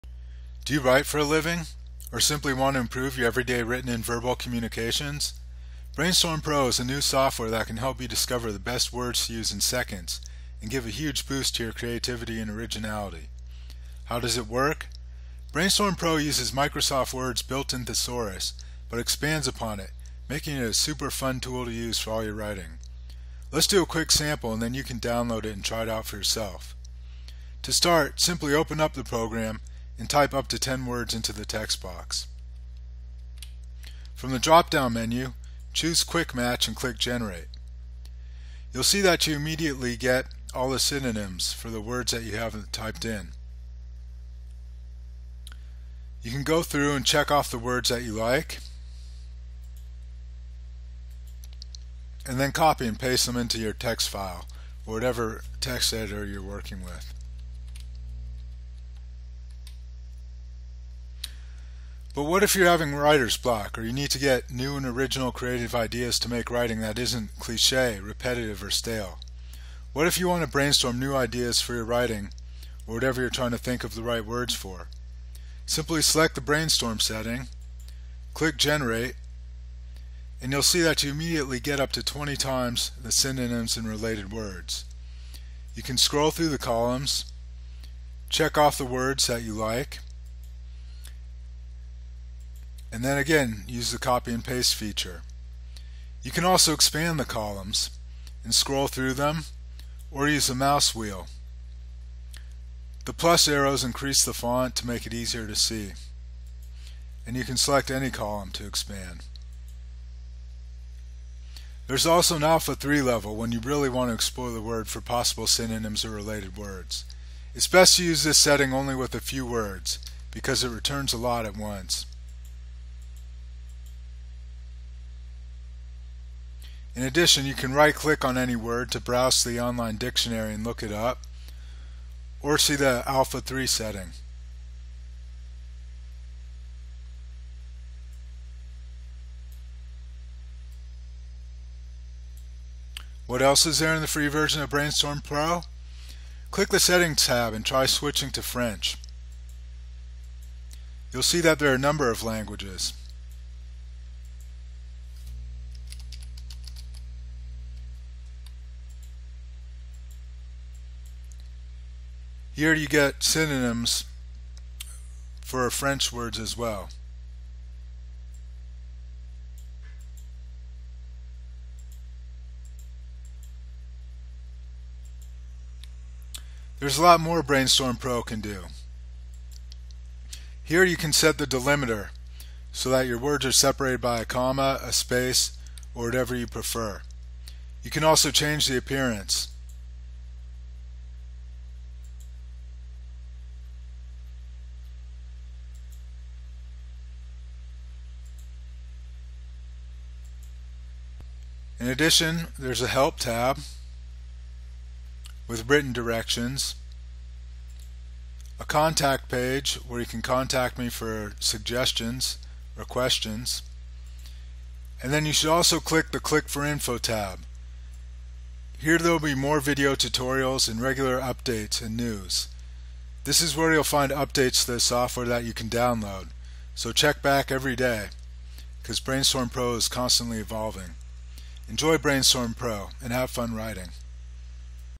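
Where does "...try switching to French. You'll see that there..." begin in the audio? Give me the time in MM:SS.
02:27.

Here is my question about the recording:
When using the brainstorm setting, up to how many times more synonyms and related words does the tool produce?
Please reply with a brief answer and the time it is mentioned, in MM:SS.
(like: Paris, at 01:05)
20, at 01:22.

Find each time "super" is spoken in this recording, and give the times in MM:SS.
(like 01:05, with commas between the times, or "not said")
00:20.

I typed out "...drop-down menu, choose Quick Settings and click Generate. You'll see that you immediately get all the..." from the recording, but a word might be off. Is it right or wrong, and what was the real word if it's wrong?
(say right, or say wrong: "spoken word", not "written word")
wrong: "Match", not "Settings".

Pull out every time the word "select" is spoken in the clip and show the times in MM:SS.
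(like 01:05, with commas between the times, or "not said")
01:16, 01:47.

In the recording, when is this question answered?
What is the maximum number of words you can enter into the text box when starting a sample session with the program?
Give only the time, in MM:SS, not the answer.
00:30.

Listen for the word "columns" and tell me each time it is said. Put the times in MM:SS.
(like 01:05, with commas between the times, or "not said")
01:26, 01:37, 01:48.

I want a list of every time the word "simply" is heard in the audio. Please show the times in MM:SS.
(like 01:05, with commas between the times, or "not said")
00:02, 00:28, 01:15.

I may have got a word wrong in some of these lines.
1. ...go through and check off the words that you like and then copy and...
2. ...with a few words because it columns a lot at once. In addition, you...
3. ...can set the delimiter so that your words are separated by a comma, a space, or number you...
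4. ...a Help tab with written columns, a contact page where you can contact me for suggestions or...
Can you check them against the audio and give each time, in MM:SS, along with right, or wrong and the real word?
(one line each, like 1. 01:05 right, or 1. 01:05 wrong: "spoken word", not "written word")
1. 00:46 right
2. 01:58 wrong: "returns", not "columns"
3. 03:00 wrong: "whatever", not "number"
4. 03:22 wrong: "directions", not "columns".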